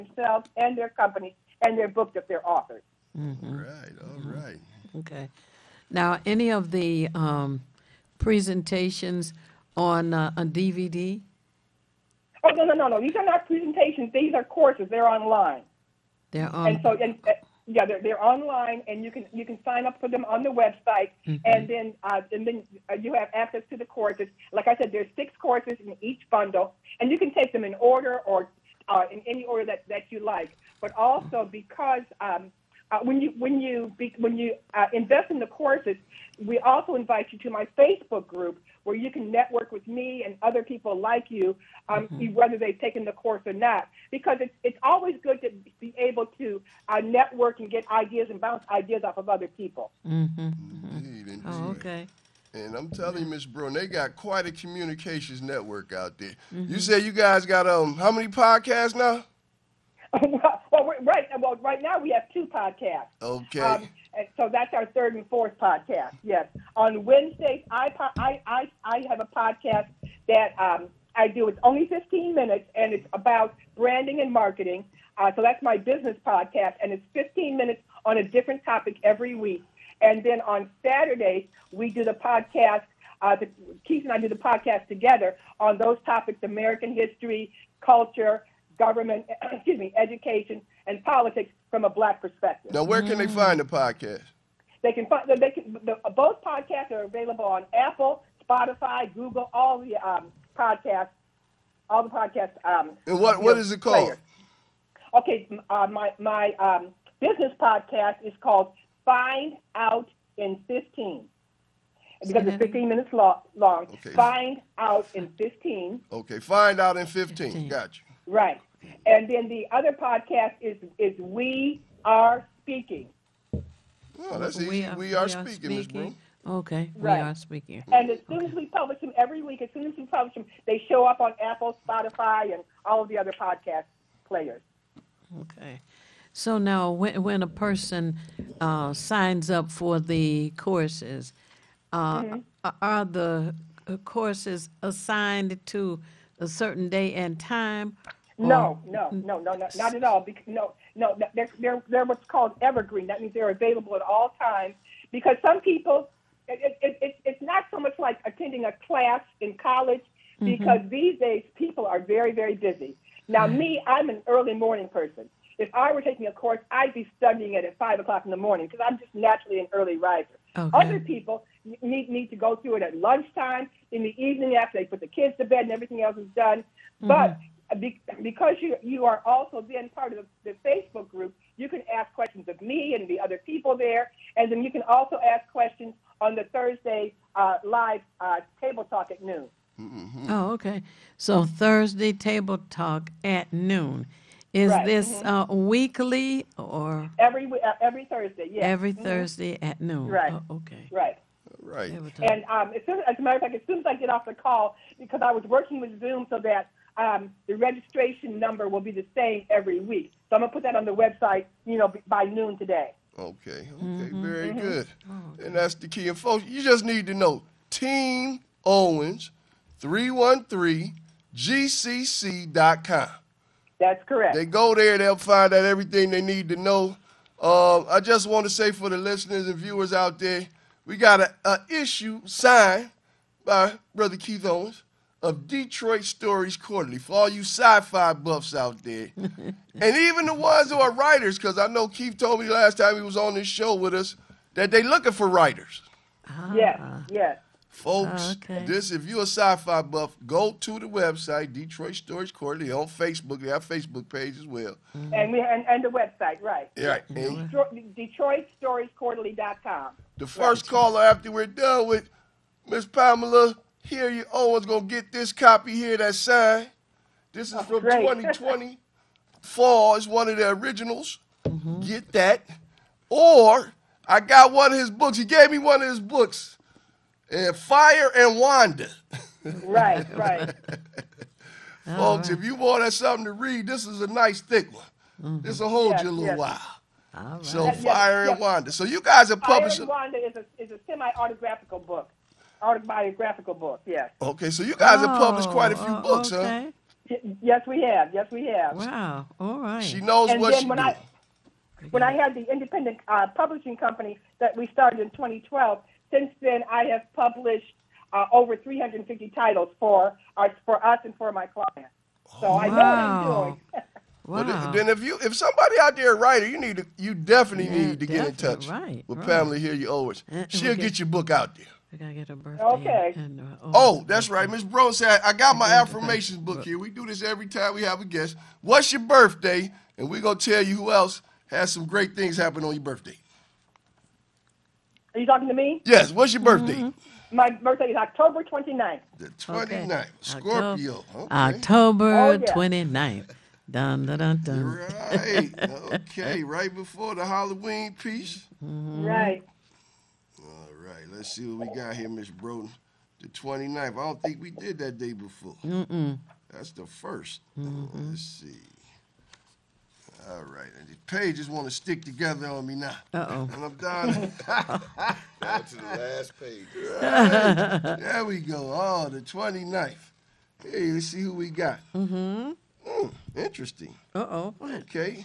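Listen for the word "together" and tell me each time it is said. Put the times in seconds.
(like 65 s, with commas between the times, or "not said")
84 s, 362 s.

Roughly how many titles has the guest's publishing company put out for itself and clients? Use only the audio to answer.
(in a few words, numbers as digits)
over 350.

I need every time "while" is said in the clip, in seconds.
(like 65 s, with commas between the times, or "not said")
287 s.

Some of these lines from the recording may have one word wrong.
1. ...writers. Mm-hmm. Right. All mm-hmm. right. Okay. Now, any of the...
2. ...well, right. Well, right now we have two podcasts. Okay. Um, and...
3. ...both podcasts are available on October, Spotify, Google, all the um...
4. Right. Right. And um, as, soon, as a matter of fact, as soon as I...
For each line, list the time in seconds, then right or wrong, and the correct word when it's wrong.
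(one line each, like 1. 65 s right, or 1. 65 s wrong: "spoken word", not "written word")
1. 2 s wrong: "authors", not "writers"
2. 60 s right
3. 96 s wrong: "Apple", not "October"
4. 200 s right.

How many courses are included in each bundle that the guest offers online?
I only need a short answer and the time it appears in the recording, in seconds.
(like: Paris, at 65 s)
6, at 25 s.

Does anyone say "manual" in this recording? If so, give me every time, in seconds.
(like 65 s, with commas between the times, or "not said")
not said.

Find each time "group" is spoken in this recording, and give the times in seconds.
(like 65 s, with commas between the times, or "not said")
38 s, 181 s.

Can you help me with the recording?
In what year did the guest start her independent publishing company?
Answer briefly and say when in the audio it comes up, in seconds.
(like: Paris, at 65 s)
2012, at 305 s.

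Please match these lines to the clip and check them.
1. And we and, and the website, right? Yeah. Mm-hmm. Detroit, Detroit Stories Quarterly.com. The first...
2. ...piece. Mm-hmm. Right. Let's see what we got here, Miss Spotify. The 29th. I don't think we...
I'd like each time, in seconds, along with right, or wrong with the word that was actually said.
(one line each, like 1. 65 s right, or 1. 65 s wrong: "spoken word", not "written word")
1. 255 s right
2. 347 s wrong: "Broden", not "Spotify".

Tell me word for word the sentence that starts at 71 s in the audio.
It's only 15 minutes, and it's about branding and marketing.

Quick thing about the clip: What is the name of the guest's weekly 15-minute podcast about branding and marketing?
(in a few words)
Find Out in Fifteen.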